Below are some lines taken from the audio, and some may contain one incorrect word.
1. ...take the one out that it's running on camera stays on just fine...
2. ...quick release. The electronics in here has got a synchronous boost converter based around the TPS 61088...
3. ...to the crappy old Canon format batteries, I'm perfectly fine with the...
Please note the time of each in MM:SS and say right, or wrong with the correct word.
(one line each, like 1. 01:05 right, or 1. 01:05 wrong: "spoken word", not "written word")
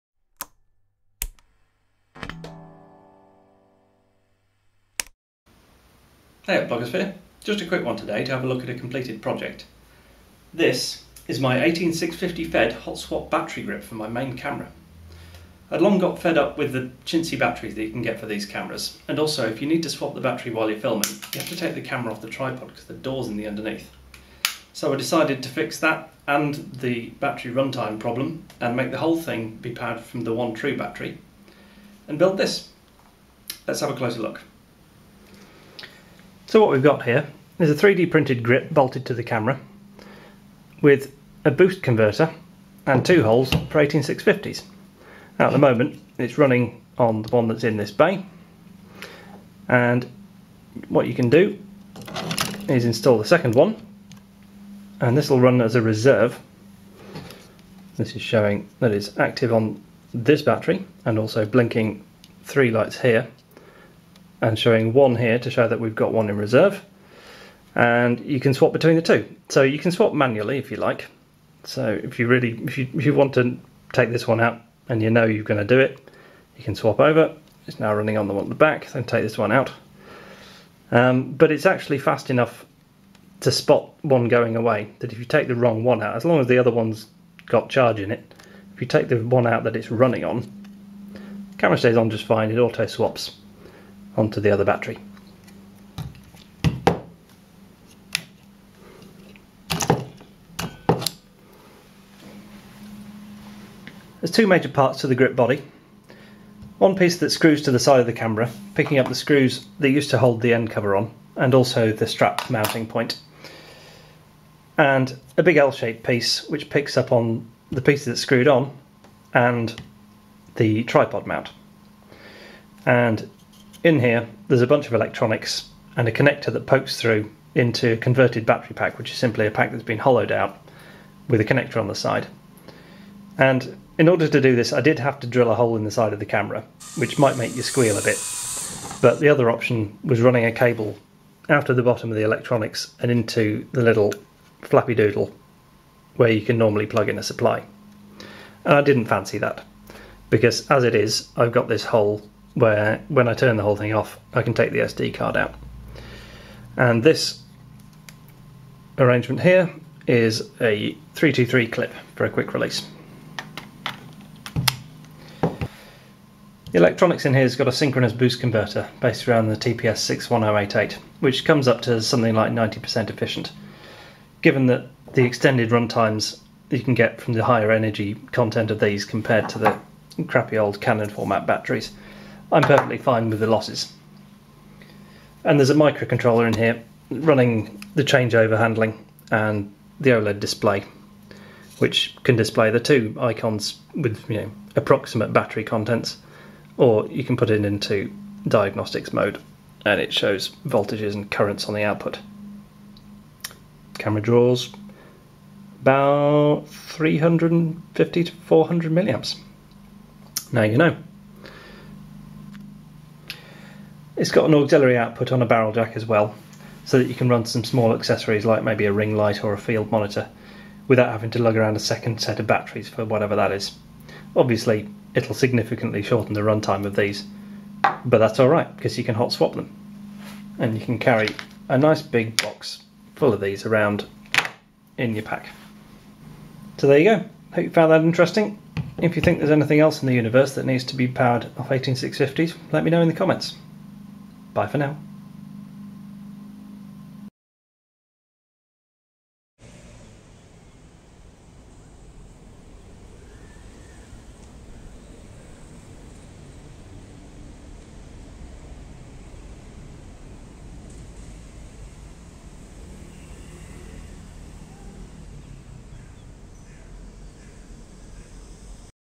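1. 01:28 right
2. 02:42 right
3. 02:59 right.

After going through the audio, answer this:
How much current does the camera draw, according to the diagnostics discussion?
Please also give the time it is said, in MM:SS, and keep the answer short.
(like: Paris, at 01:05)
350 to 400 milliamps, at 03:26.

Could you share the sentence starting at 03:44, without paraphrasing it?
Obviously, it'll significantly shorten the runtime of these, but that's alright because you can hot swap them.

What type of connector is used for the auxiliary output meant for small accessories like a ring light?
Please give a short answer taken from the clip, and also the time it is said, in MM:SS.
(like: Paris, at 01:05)
Barrel jack, at 03:35.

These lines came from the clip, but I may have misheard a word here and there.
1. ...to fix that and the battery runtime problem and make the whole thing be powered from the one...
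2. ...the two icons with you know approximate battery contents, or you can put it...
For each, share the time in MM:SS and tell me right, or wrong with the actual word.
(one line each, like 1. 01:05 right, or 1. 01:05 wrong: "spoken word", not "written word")
1. 00:25 right
2. 03:12 right.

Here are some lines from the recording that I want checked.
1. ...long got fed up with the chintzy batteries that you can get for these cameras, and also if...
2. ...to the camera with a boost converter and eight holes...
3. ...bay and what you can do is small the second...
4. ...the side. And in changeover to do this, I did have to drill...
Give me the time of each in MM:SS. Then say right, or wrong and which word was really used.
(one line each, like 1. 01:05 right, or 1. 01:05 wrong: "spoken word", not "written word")
1. 00:15 right
2. 00:39 wrong: "two", not "eight"
3. 00:47 wrong: "install", not "small"
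4. 02:11 wrong: "order", not "changeover".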